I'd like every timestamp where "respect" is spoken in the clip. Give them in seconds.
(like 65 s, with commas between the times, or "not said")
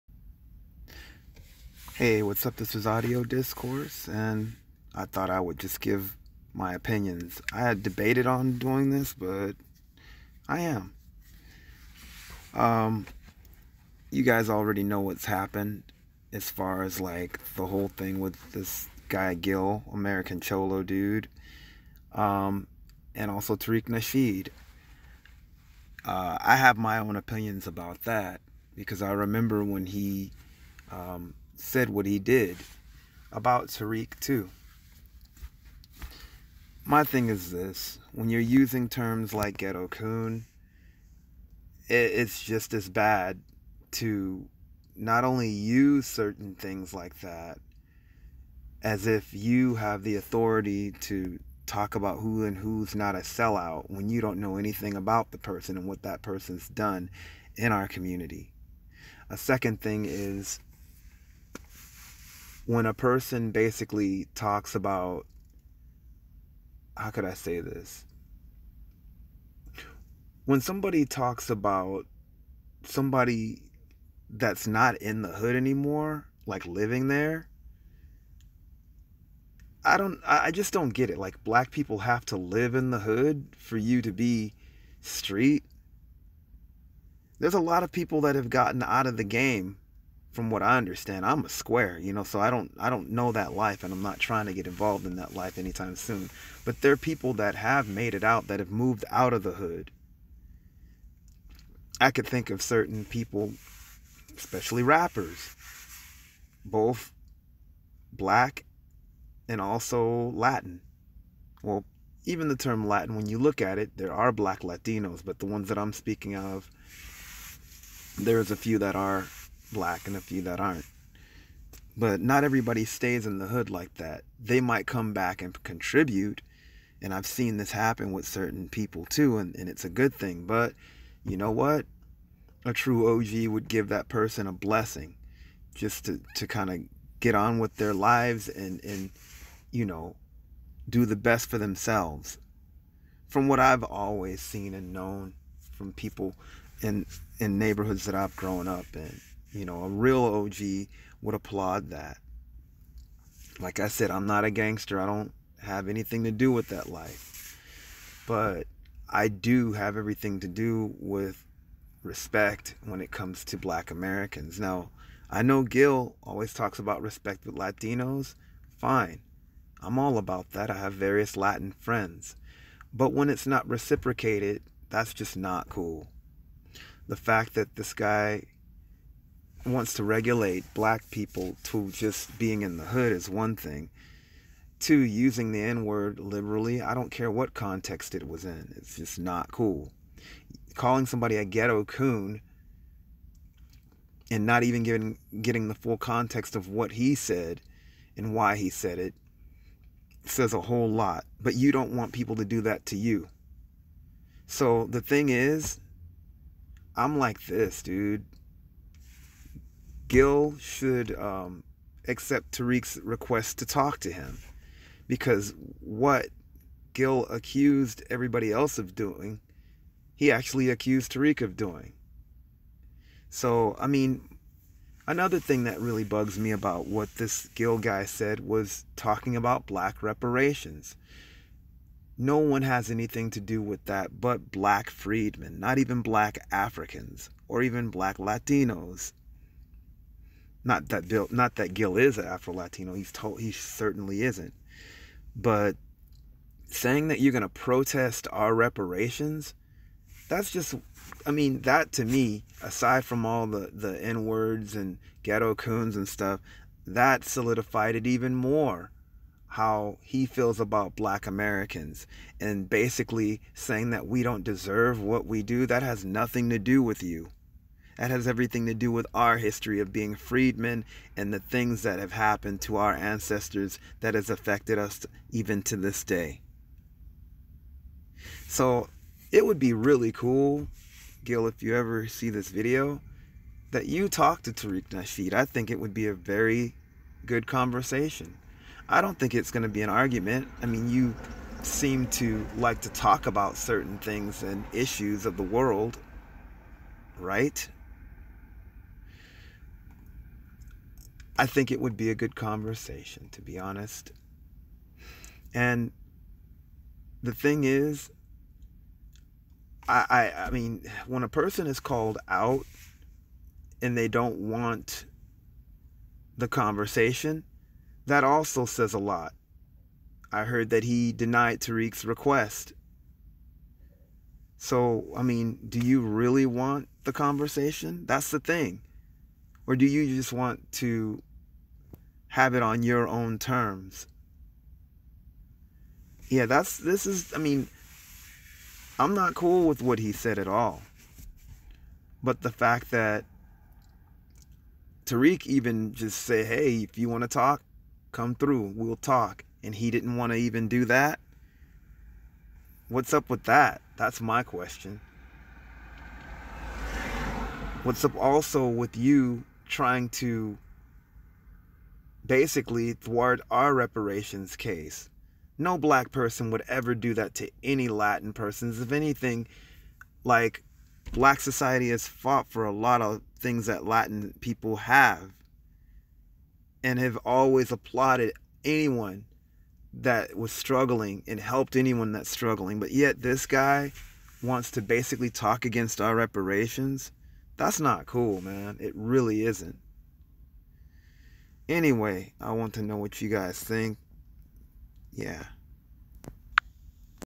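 162 s, 167 s.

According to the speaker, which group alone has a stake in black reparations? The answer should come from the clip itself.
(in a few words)
black freedmen.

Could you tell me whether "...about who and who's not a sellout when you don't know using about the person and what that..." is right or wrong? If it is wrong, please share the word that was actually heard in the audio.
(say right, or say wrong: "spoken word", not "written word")
wrong: "anything", not "using".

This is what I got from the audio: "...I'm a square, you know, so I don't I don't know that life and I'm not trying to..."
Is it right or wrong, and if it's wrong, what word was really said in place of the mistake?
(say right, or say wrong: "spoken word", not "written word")
right.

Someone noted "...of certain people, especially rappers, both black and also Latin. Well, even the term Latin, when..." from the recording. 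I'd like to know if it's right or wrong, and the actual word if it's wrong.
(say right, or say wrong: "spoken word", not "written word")
right.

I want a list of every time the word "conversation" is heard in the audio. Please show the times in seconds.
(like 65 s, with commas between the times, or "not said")
287 s, 302 s, 316 s, 327 s.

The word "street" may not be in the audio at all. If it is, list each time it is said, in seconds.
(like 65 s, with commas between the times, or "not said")
85 s.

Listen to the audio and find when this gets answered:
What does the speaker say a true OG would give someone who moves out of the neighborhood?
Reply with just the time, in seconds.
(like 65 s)
134 s.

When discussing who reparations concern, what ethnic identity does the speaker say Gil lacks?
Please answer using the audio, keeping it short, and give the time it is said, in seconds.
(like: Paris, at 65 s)
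Afro Latino, at 242 s.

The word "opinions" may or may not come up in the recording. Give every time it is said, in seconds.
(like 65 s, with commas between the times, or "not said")
6 s, 27 s.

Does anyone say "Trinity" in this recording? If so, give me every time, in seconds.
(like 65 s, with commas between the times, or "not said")
not said.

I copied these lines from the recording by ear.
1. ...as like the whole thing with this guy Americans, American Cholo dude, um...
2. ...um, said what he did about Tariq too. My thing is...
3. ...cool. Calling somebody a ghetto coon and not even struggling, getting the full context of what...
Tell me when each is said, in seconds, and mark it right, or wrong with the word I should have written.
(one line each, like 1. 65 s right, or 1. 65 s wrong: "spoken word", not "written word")
1. 16 s wrong: "Gil", not "Americans"
2. 30 s right
3. 189 s wrong: "giving", not "struggling".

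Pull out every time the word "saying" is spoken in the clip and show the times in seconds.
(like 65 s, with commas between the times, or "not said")
246 s, 263 s.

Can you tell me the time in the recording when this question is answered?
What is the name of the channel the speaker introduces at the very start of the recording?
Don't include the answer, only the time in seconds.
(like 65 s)
2 s.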